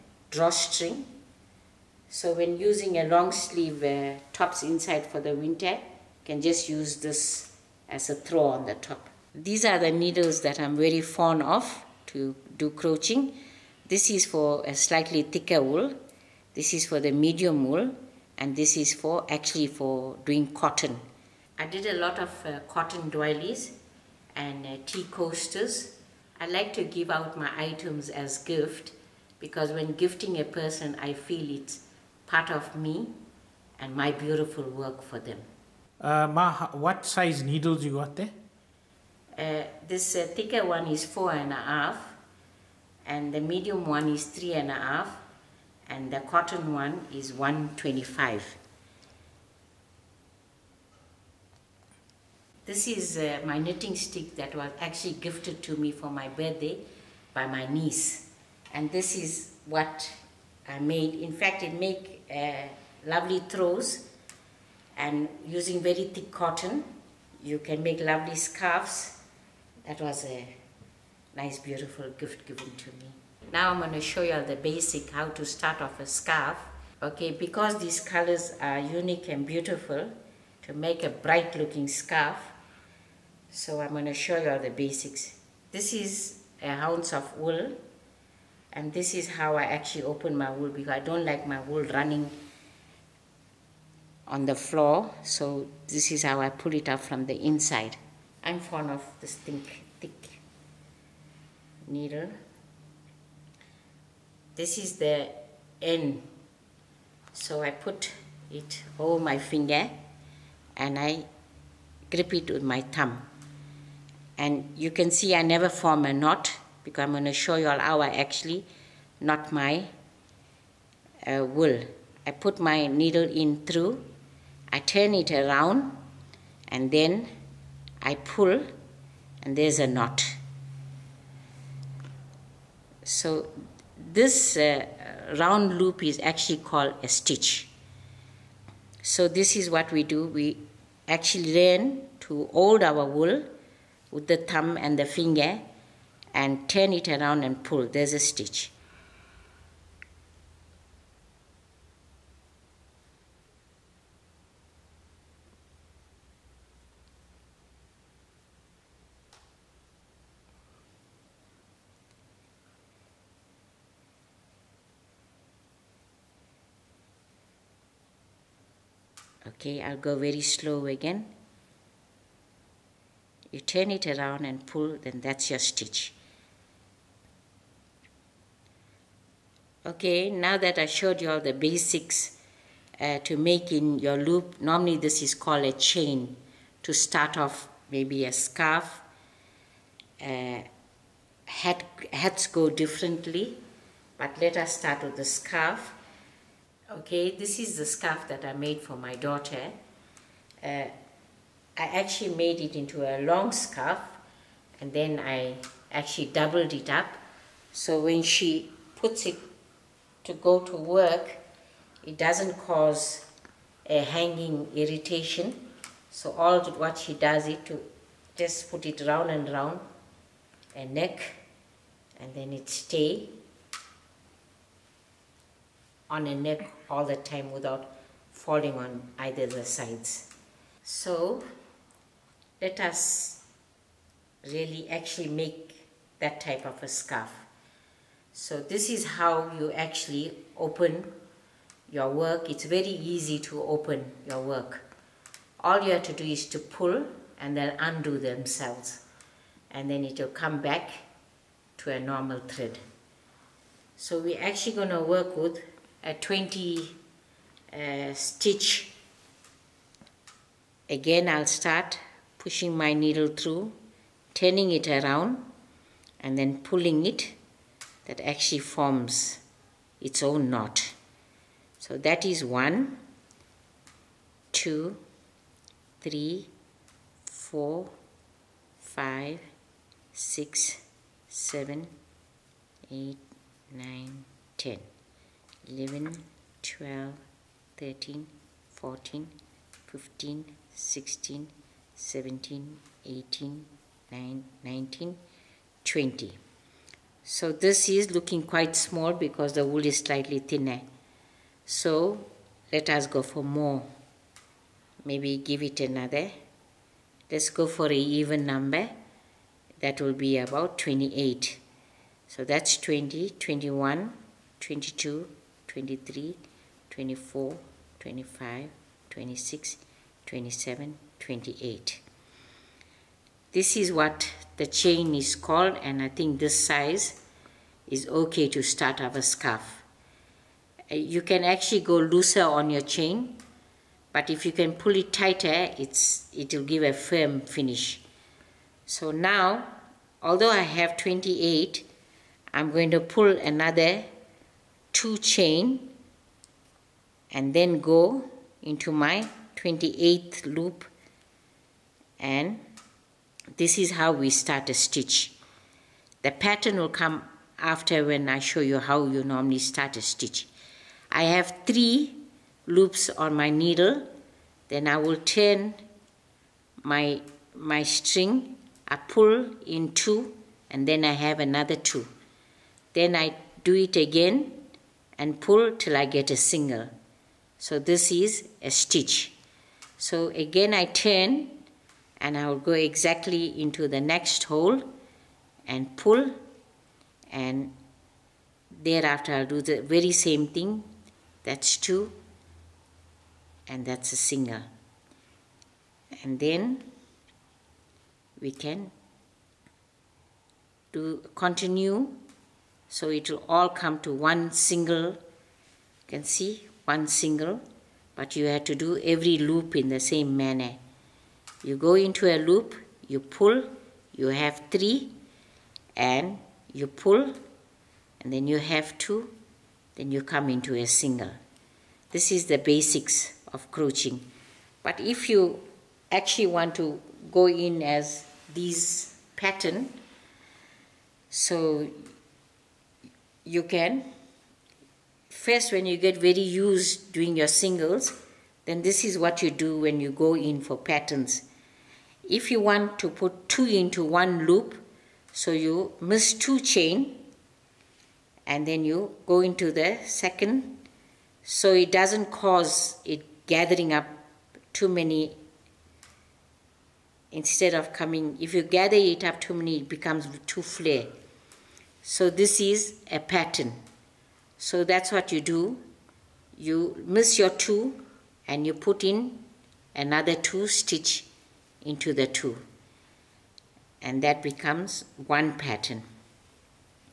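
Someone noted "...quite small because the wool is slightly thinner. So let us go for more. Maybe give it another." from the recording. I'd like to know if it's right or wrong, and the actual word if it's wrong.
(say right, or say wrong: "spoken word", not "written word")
right.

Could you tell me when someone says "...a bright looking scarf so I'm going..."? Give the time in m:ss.
1:21.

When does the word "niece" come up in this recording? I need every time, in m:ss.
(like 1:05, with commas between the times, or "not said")
0:57.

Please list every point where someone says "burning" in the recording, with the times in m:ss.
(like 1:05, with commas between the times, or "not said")
not said.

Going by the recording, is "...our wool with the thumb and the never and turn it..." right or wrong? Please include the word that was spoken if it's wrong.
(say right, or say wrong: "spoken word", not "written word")
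wrong: "finger", not "never".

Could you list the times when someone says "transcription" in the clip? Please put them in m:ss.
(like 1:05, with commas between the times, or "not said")
not said.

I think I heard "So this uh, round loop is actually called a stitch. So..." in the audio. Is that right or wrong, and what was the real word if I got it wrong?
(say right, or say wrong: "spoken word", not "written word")
right.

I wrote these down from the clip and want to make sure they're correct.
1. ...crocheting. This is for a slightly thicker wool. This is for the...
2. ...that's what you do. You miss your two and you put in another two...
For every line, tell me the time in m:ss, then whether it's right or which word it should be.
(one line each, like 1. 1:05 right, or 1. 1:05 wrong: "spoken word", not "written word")
1. 0:12 right
2. 7:44 right.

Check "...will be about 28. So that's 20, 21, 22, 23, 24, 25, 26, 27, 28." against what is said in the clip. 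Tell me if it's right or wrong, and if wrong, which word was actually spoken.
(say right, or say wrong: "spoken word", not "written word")
right.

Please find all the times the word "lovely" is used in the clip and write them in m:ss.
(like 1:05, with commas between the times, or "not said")
1:03, 1:07.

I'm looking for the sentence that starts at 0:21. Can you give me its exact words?
I did a lot of uh, cotton doilies and uh, tea coasters.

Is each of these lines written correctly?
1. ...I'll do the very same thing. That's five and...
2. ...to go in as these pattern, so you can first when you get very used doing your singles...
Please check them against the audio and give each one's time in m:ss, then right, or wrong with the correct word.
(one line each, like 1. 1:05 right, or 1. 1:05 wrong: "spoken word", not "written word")
1. 6:29 wrong: "two", not "five"
2. 7:06 right.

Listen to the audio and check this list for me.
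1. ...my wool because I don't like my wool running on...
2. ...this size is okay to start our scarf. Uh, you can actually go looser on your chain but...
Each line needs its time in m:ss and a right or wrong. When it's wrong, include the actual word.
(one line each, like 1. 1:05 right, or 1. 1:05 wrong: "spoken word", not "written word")
1. 1:30 right
2. 5:26 right.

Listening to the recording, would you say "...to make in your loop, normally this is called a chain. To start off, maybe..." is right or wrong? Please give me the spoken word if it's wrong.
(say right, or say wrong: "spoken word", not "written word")
right.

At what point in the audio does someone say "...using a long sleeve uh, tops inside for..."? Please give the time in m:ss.
0:02.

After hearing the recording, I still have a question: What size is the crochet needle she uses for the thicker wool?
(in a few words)
4.5.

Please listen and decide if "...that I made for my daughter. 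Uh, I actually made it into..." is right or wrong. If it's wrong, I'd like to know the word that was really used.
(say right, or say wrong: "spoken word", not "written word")
right.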